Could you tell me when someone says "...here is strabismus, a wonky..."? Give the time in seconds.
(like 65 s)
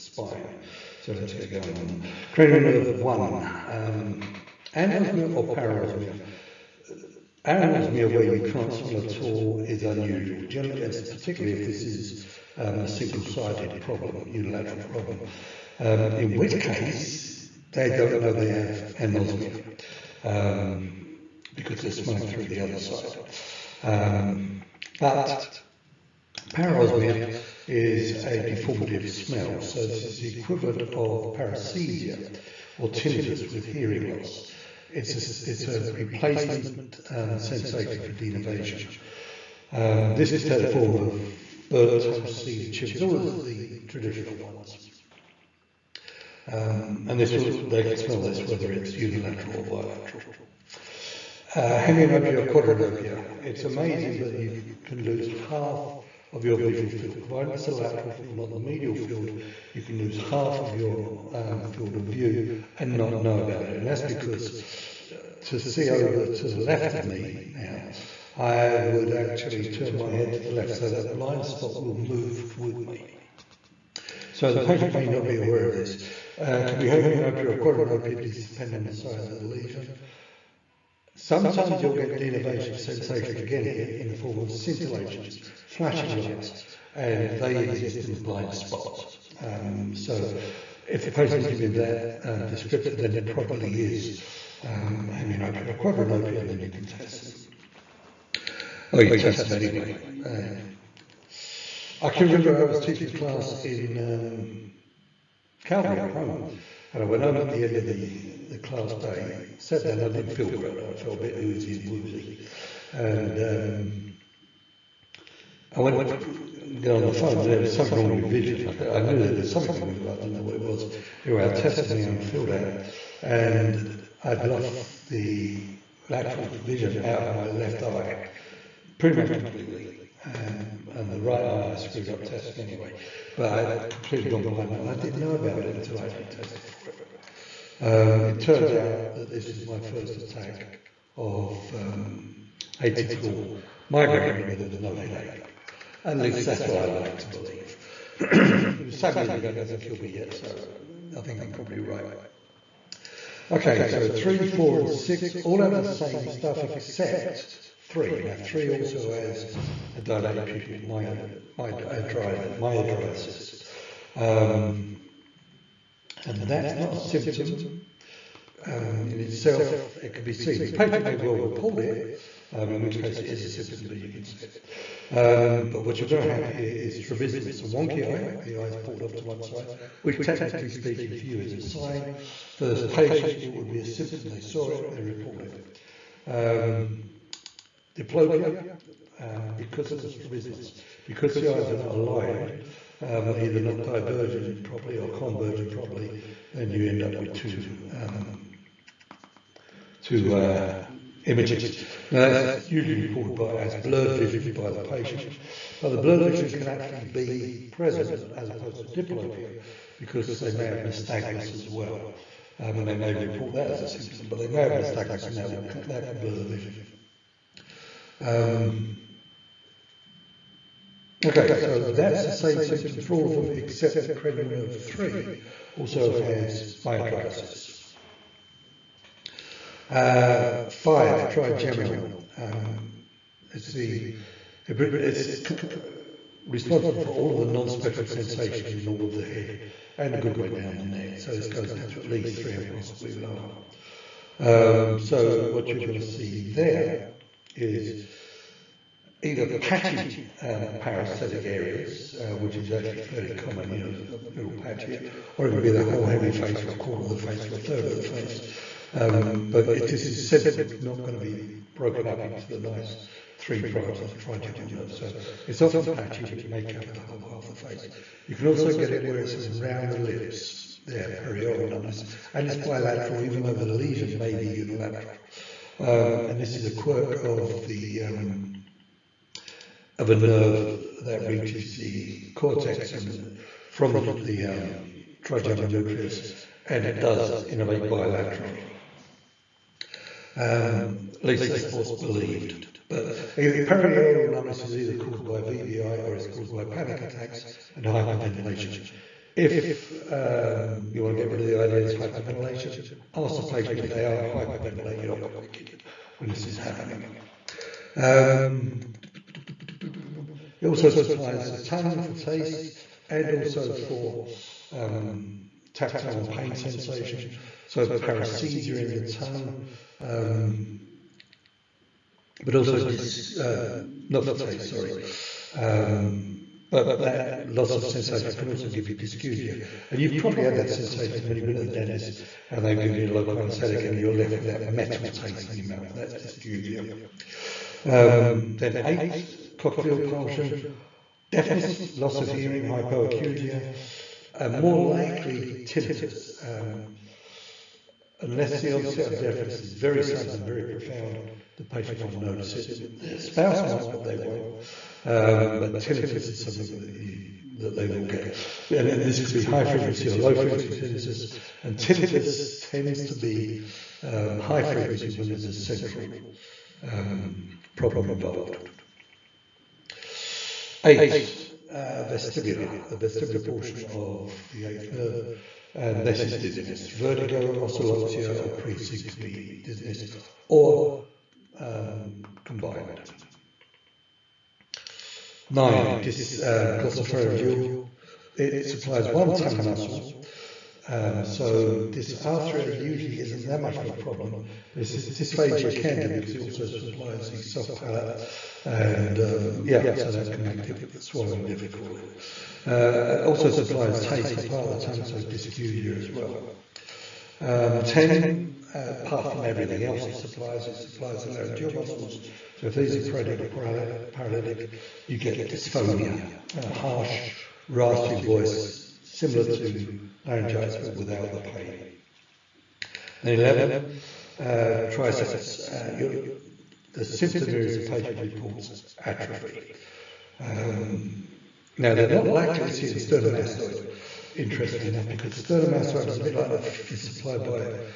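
176 s.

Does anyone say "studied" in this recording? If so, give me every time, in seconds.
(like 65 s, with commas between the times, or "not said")
not said.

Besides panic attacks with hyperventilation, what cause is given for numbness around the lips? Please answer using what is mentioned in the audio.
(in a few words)
VBI.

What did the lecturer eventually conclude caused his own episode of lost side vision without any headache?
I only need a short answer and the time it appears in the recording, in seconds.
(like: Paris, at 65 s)
Atypical migraine, at 142 s.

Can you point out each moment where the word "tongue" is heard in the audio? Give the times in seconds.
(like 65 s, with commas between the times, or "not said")
311 s, 319 s, 389 s, 404 s.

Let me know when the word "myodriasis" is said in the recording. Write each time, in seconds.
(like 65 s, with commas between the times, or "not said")
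161 s, 226 s.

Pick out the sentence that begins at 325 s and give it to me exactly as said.
Um, but that loss of sensation can also give you dysgeusia.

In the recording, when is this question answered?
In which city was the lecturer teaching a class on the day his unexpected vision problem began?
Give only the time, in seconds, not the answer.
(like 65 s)
105 s.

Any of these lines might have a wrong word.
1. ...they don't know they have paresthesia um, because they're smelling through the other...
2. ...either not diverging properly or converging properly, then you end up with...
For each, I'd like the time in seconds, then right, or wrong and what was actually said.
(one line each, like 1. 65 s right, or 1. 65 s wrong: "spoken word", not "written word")
1. 17 s wrong: "anosmia", not "paresthesia"
2. 193 s right.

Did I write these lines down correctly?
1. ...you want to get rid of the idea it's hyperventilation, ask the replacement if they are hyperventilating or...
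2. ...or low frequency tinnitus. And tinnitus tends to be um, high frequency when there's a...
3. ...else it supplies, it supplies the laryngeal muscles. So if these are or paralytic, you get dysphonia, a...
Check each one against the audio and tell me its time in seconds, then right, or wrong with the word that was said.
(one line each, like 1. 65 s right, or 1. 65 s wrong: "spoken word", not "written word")
1. 300 s wrong: "patient", not "replacement"
2. 360 s right
3. 409 s right.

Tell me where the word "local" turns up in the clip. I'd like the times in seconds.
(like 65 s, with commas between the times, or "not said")
333 s.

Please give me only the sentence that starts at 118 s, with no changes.
Like I knew there was something wrong with it, but I didn't know what it was.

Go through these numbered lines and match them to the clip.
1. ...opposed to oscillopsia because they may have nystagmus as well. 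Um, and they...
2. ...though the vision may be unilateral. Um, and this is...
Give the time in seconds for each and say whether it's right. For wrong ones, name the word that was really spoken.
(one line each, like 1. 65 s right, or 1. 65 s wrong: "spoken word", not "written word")
1. 208 s wrong: "diplopia", not "oscillopsia"
2. 273 s wrong: "lesion", not "vision".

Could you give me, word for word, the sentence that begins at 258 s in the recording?
Um, but if this is central, it's not going to be broken up into the nice three branches of the trigeminal nerve.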